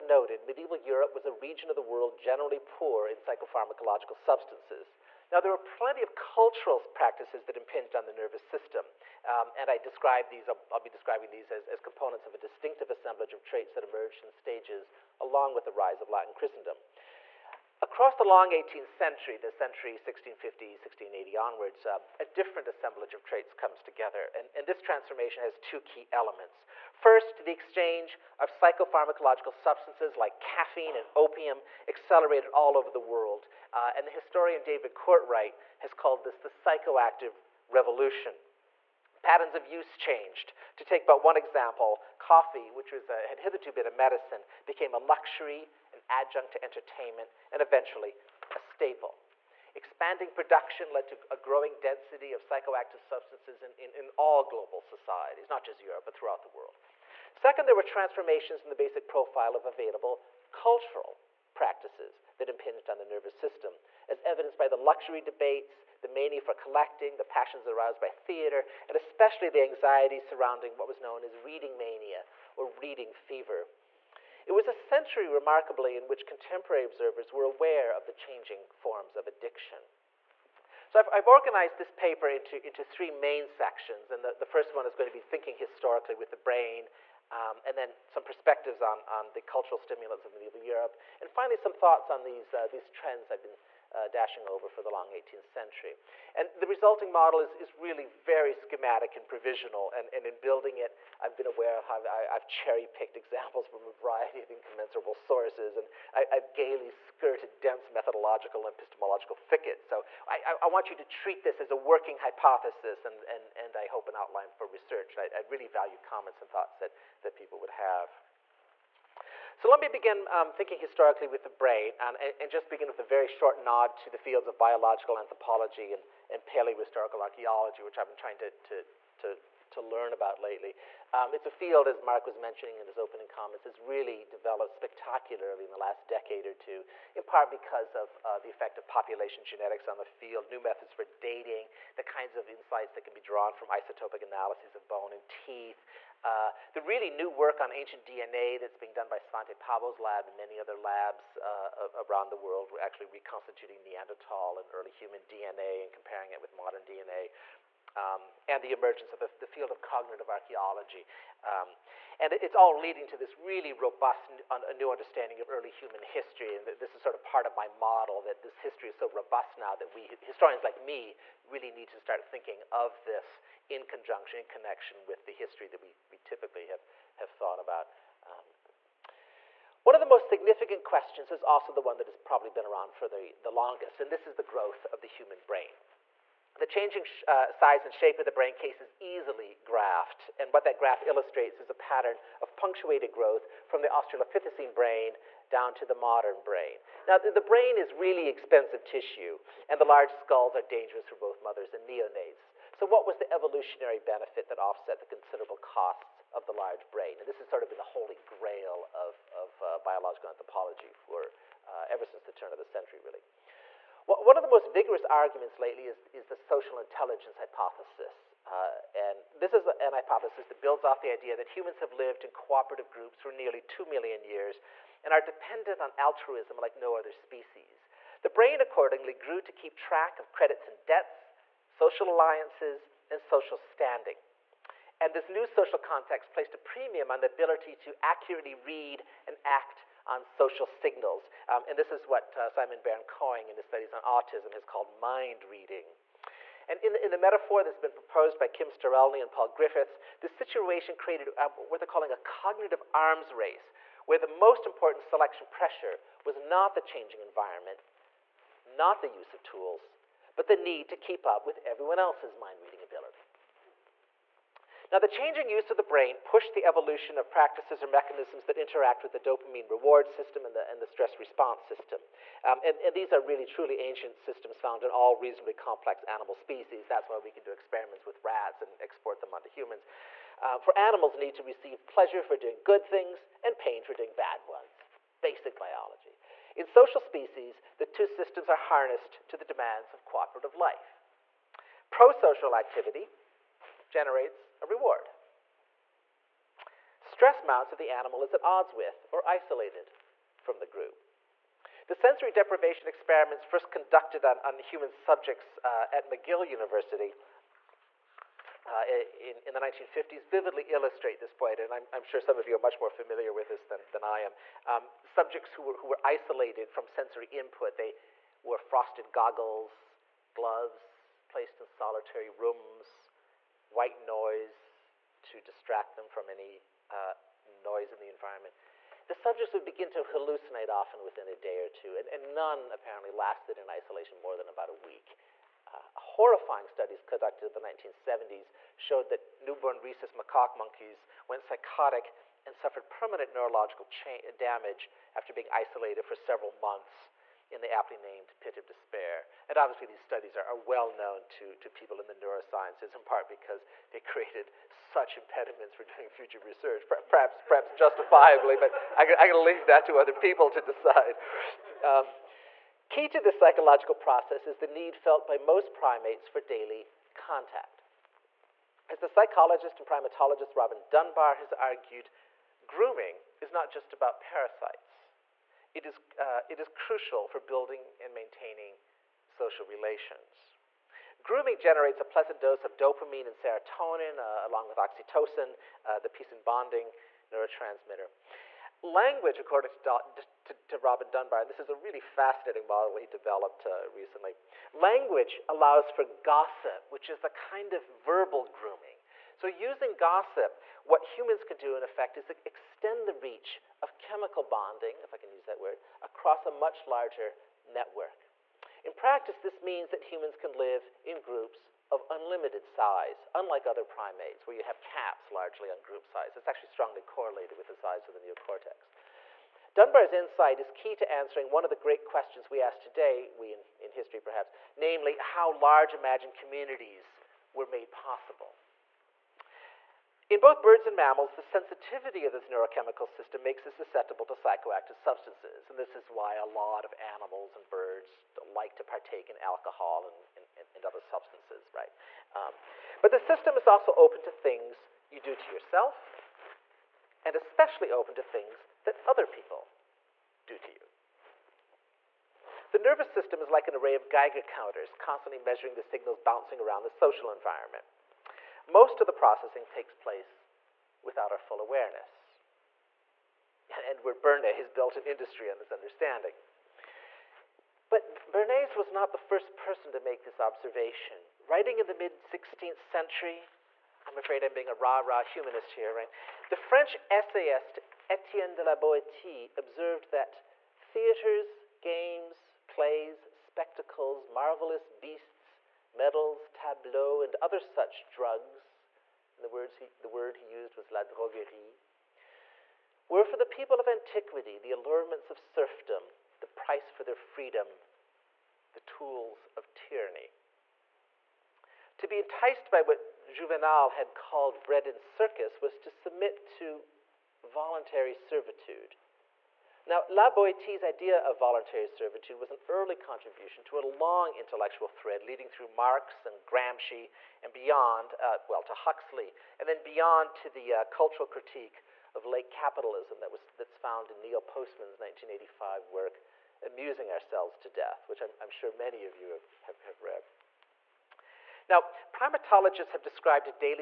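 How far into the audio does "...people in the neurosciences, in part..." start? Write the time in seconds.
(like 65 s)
351 s.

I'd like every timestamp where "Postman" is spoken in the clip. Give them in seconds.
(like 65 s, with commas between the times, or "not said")
524 s.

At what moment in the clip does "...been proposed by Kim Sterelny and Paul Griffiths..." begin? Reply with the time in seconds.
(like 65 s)
247 s.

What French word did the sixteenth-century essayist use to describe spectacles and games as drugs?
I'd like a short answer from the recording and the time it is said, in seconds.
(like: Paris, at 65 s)
la droguerie, at 490 s.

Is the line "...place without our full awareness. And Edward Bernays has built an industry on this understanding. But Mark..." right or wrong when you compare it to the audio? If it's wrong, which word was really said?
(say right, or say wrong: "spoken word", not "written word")
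wrong: "Bernays", not "Mark".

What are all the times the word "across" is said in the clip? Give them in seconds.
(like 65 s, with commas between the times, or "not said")
17 s, 406 s.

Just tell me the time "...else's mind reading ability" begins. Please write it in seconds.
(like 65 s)
262 s.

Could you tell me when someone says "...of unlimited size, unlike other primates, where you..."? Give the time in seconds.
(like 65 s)
411 s.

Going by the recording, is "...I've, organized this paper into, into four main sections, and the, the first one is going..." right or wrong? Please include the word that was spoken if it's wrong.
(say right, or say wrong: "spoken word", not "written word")
wrong: "three", not "four".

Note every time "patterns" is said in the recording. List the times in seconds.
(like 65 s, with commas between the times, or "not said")
39 s, 191 s.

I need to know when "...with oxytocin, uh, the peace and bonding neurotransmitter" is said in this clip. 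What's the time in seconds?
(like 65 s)
384 s.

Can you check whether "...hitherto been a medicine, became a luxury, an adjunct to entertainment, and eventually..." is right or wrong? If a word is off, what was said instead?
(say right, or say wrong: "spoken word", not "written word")
right.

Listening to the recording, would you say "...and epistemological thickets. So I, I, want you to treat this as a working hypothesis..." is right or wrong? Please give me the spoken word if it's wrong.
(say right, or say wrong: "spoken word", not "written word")
right.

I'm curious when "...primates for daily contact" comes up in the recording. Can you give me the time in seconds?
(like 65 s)
365 s.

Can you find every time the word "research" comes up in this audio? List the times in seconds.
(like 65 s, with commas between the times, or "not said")
114 s, 356 s.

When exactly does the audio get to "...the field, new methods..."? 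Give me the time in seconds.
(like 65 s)
139 s.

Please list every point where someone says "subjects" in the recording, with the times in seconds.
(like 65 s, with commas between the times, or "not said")
304 s, 315 s, 329 s.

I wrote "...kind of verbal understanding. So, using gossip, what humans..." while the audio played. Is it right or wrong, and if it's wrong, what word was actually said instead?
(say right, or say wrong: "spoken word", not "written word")
wrong: "grooming", not "understanding".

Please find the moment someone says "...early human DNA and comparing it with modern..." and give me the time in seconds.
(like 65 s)
154 s.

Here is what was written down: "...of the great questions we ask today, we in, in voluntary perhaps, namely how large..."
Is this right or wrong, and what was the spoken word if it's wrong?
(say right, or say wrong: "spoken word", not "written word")
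wrong: "history", not "voluntary".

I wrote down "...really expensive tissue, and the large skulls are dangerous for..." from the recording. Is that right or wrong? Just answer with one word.
right.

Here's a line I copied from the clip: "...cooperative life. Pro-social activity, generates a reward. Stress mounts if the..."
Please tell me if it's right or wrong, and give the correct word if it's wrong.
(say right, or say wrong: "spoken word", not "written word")
right.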